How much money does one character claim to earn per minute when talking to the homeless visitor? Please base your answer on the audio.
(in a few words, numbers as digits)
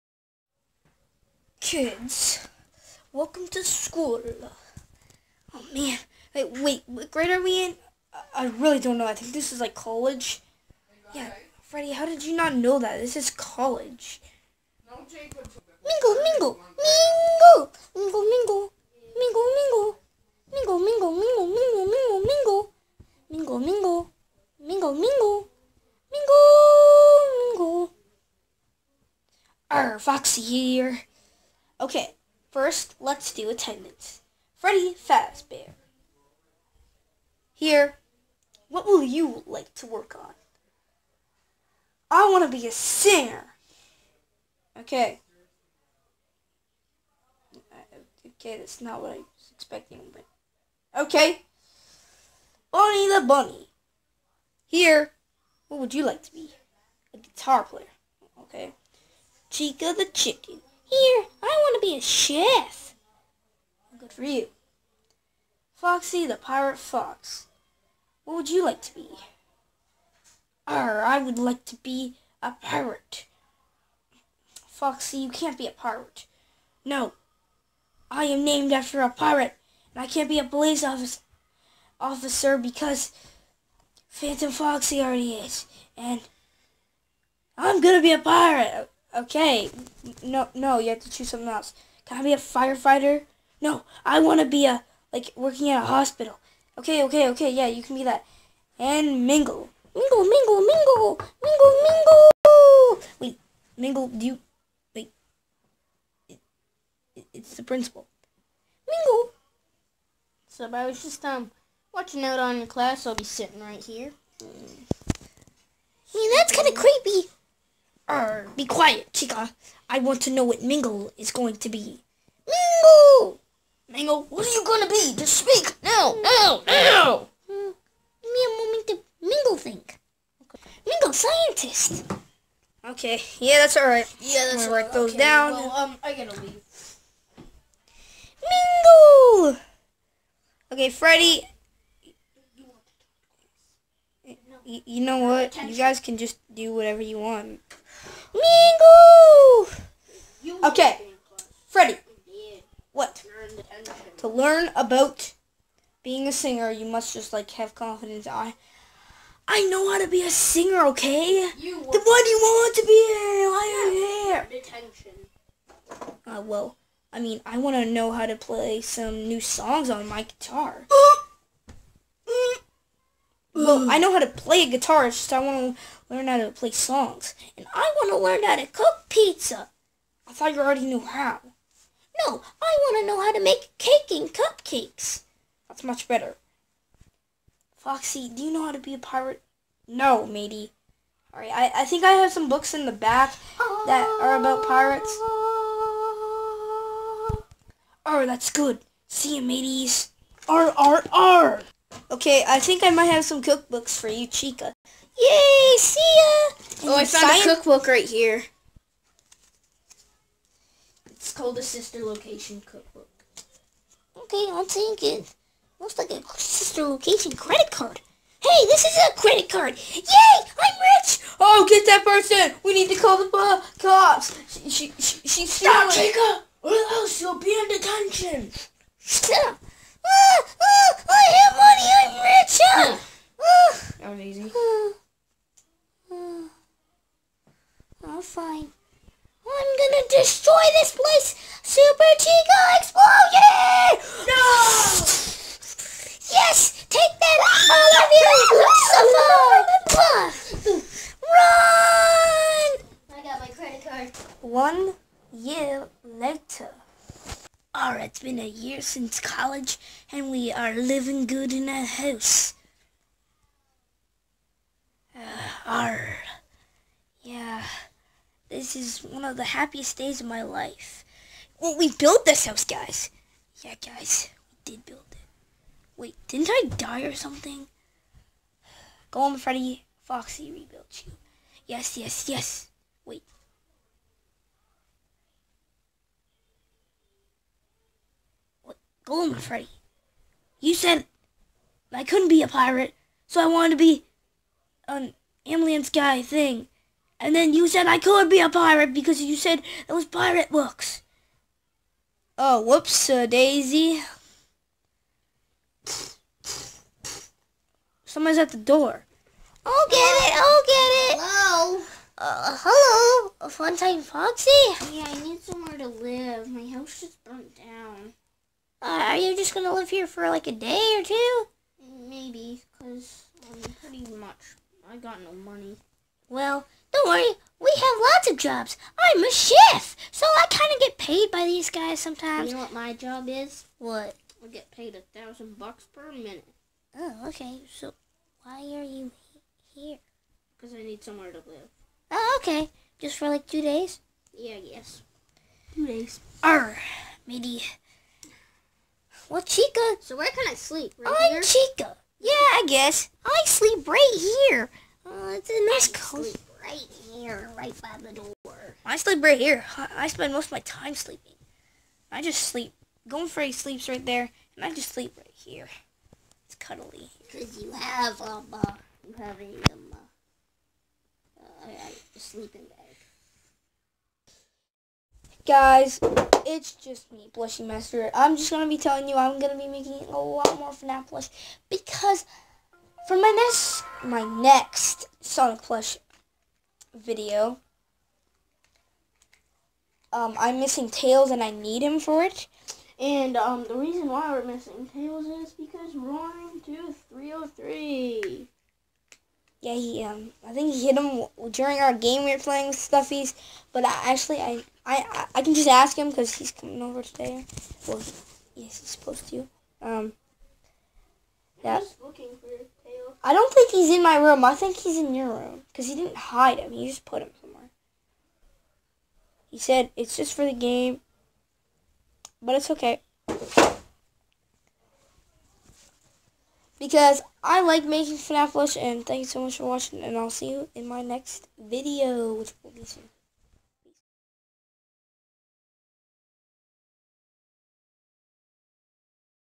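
1000 bucks.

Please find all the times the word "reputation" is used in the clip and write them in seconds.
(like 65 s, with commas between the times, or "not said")
not said.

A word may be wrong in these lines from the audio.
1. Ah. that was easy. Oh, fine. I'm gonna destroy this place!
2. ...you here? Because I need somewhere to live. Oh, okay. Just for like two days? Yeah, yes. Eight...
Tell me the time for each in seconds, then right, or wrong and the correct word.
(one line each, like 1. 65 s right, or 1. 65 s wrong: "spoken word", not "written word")
1. 232 s right
2. 338 s wrong: "Two", not "Eight".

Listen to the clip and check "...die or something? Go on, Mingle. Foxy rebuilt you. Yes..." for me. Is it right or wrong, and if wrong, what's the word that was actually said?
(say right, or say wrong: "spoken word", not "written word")
wrong: "Freddy", not "Mingle".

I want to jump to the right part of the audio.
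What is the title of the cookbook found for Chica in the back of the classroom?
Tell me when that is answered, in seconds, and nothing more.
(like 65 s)
211 s.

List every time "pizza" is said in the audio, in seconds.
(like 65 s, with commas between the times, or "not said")
179 s.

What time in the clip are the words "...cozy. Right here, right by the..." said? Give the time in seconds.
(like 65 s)
355 s.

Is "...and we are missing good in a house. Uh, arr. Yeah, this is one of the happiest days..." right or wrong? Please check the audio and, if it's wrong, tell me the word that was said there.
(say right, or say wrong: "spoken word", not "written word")
wrong: "living", not "missing".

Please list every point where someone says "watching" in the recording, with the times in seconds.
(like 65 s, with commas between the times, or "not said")
111 s, 429 s.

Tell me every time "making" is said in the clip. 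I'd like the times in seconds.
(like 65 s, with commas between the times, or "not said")
379 s, 427 s.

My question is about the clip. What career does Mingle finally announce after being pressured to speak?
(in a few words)
Scientist.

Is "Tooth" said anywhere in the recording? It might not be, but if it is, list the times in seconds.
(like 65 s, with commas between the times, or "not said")
396 s.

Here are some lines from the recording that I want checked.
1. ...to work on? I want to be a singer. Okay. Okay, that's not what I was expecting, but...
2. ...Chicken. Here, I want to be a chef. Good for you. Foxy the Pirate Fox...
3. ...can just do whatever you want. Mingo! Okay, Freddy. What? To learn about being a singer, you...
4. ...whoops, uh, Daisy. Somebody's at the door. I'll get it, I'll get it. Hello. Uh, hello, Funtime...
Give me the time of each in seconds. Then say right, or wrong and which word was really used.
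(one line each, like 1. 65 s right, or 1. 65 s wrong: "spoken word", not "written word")
1. 39 s right
2. 60 s right
3. 145 s right
4. 302 s right.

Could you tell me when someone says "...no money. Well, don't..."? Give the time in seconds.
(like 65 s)
325 s.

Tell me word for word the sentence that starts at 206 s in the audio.
And oh, I found a cookbook right here.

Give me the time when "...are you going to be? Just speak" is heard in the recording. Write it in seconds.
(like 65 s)
124 s.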